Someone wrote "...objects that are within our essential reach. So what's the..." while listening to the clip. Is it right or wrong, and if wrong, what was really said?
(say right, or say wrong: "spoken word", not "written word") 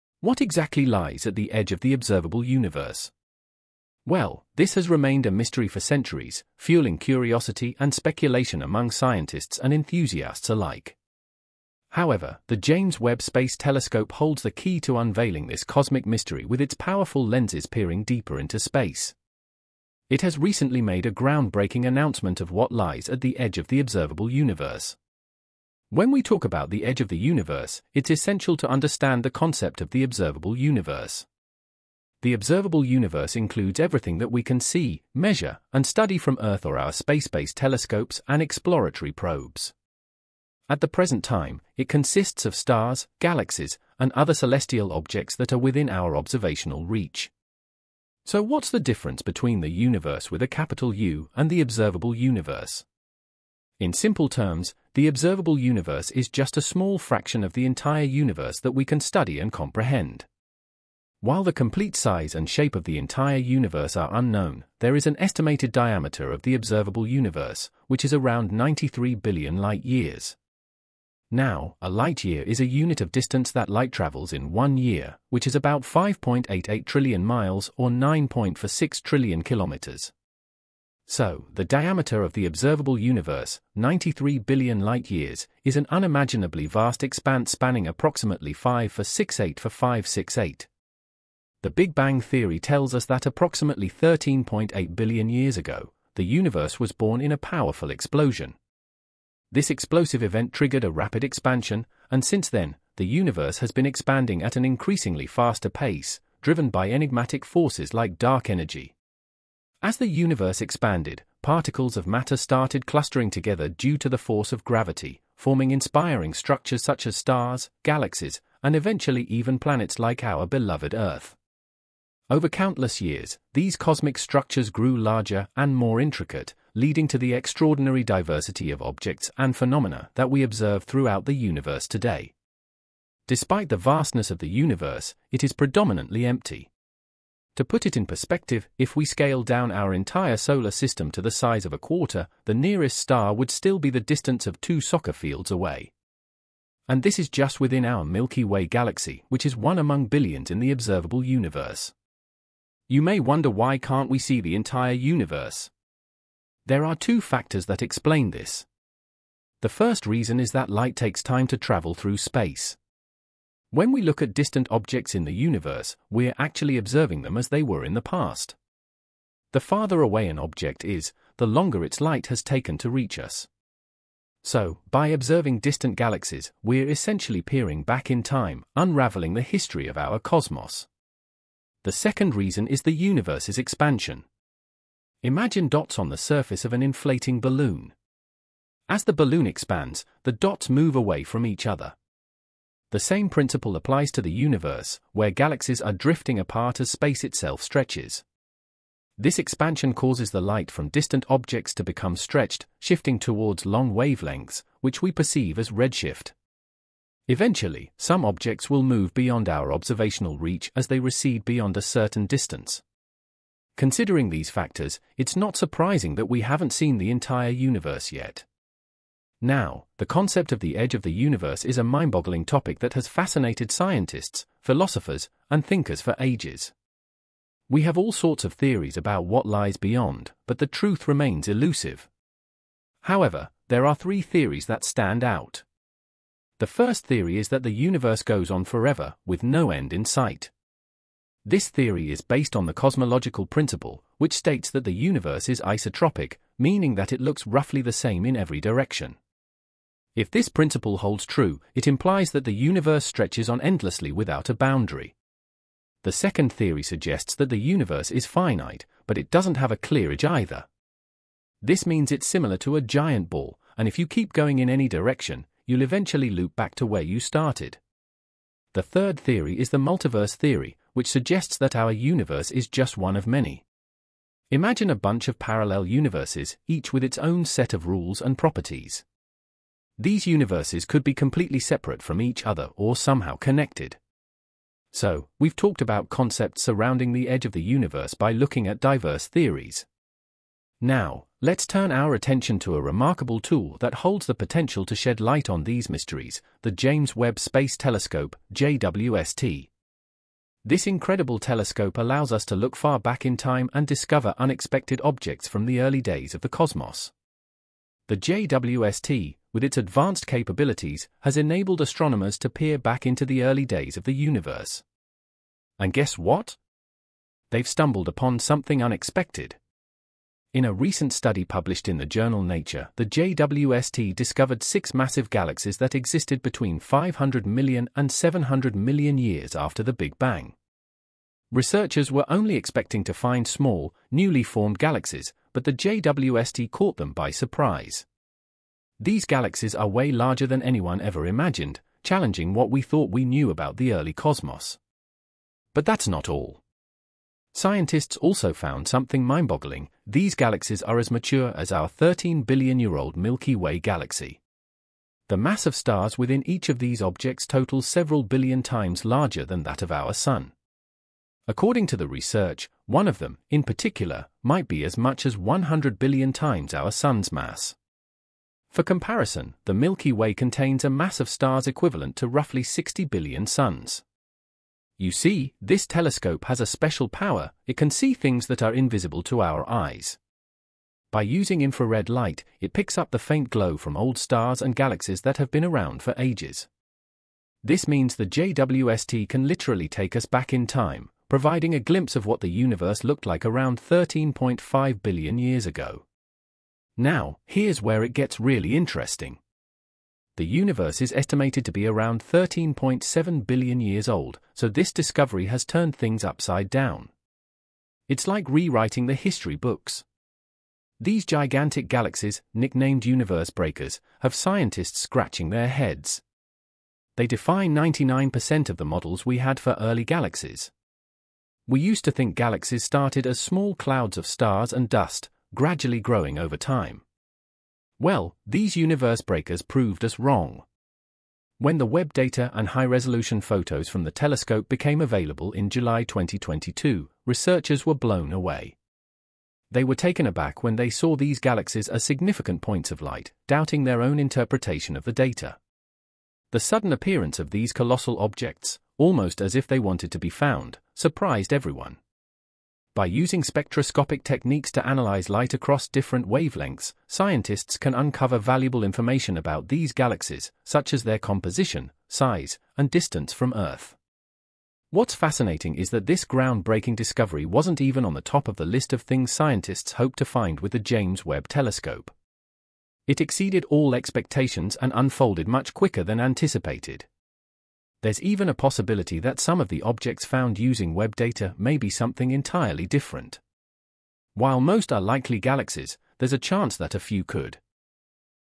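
wrong: "observational", not "essential".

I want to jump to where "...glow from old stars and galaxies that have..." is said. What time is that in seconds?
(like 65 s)
383 s.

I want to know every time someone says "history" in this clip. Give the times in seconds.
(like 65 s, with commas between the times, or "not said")
179 s, 409 s.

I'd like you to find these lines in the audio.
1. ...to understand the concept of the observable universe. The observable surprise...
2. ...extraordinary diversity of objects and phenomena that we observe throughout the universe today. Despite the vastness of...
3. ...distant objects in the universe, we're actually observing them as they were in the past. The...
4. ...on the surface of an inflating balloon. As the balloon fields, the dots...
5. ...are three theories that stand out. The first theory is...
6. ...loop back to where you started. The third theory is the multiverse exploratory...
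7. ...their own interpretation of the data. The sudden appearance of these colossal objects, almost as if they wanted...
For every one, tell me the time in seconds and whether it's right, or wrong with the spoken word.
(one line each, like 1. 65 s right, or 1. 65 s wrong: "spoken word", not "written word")
1. 28 s wrong: "universe", not "surprise"
2. 127 s right
3. 164 s right
4. 185 s wrong: "expands", not "fields"
5. 233 s right
6. 266 s wrong: "theory", not "exploratory"
7. 443 s right.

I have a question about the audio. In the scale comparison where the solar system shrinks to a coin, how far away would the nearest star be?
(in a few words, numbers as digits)
two soccer fields.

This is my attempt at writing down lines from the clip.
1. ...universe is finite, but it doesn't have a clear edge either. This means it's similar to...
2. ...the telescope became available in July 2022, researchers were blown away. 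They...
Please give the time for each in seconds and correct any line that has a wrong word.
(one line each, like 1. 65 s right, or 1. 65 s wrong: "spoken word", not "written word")
1. 257 s right
2. 434 s right.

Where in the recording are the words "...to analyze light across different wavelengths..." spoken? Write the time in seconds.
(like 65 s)
454 s.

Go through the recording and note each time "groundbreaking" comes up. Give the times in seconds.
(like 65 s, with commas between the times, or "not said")
21 s, 466 s.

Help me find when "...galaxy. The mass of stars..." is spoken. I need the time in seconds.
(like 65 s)
353 s.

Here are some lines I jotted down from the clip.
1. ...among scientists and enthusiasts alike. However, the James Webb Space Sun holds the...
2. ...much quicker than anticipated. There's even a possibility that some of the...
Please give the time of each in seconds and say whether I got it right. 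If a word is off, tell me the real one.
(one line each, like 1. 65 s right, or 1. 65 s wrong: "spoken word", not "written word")
1. 8 s wrong: "Telescope", not "Sun"
2. 475 s right.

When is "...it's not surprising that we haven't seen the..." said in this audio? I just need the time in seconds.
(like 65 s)
215 s.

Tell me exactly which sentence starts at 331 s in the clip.
Researchers were only expecting to find small, newly formed galaxies, but the JWST caught them by surprise.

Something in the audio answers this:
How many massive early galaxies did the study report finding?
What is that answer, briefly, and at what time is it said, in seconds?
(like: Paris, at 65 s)
6, at 324 s.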